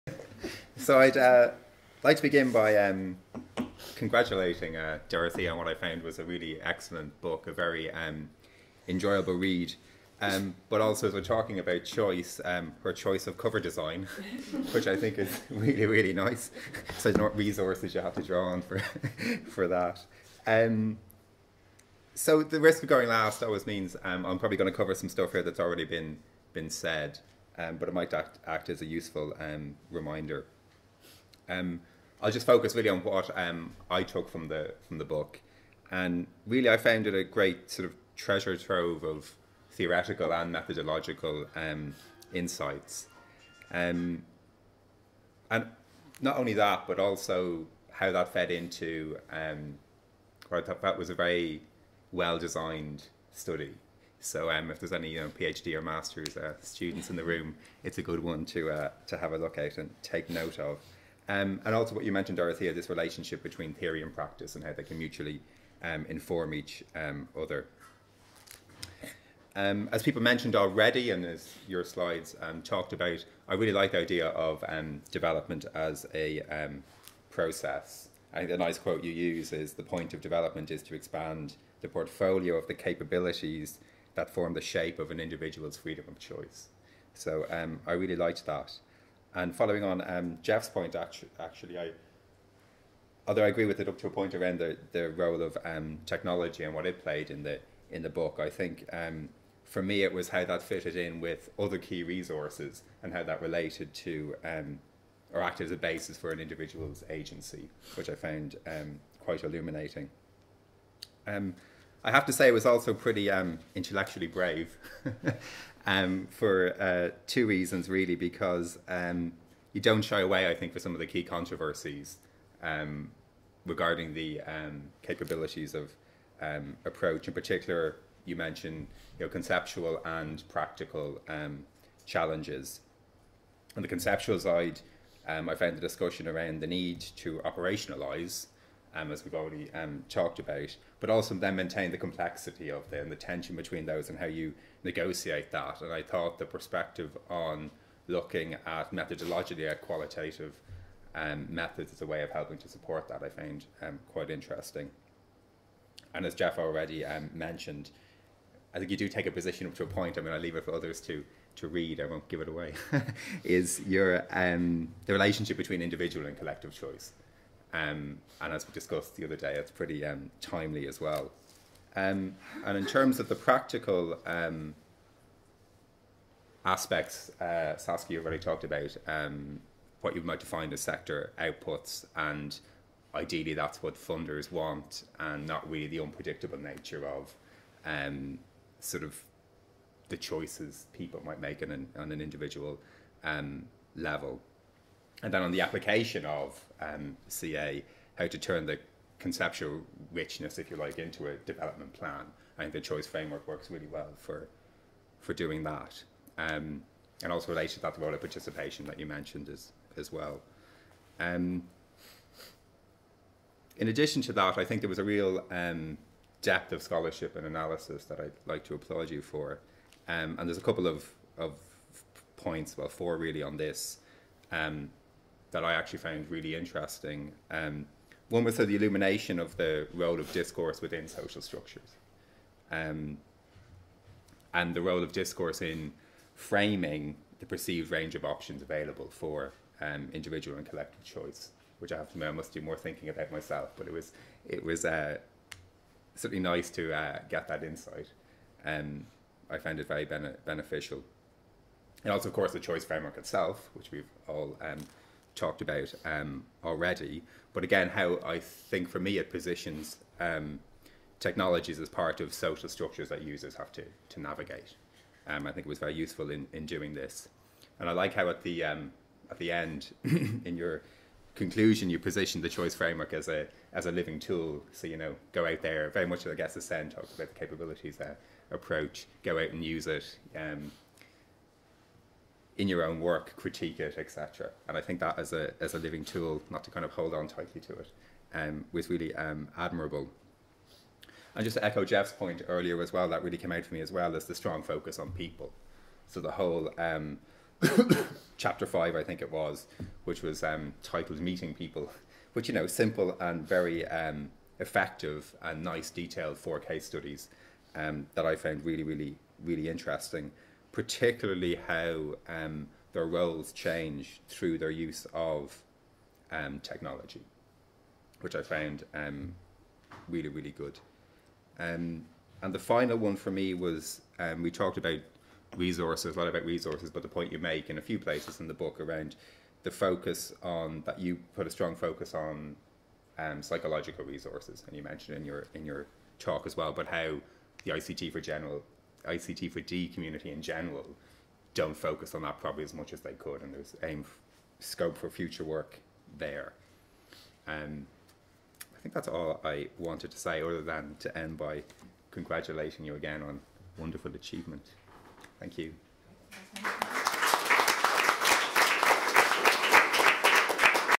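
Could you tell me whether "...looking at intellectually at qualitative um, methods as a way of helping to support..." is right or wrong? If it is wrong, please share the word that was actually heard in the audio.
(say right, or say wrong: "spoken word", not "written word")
wrong: "methodologically", not "intellectually".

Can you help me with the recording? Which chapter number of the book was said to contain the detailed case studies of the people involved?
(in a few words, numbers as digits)
5.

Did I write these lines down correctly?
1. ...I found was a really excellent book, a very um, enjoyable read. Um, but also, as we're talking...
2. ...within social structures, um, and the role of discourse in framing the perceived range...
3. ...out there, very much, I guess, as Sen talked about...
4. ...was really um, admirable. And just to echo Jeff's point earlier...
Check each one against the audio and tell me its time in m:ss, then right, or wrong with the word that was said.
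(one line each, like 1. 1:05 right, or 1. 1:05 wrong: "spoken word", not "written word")
1. 0:05 right
2. 3:50 right
3. 4:35 right
4. 4:48 right.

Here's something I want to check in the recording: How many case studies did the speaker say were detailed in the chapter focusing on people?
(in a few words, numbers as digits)
4.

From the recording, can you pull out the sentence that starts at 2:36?
And as Jeff already um, mentioned, I think you do take a position up to a point.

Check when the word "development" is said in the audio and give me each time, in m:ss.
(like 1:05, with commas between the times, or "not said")
1:15, 1:20, 3:21.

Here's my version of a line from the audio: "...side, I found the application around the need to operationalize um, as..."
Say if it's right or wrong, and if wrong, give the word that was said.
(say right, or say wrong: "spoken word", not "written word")
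wrong: "discussion", not "application".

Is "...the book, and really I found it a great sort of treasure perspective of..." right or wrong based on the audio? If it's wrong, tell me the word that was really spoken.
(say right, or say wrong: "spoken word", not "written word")
wrong: "trove", not "perspective".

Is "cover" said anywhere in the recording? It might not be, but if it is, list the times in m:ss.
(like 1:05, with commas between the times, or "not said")
0:13, 0:24.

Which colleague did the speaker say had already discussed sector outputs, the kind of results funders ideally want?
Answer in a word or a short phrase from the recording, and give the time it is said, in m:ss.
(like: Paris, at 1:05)
Saskia, at 2:57.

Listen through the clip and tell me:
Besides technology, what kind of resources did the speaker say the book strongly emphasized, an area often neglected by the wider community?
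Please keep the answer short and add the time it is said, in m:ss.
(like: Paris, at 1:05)
Psychological resources, at 5:33.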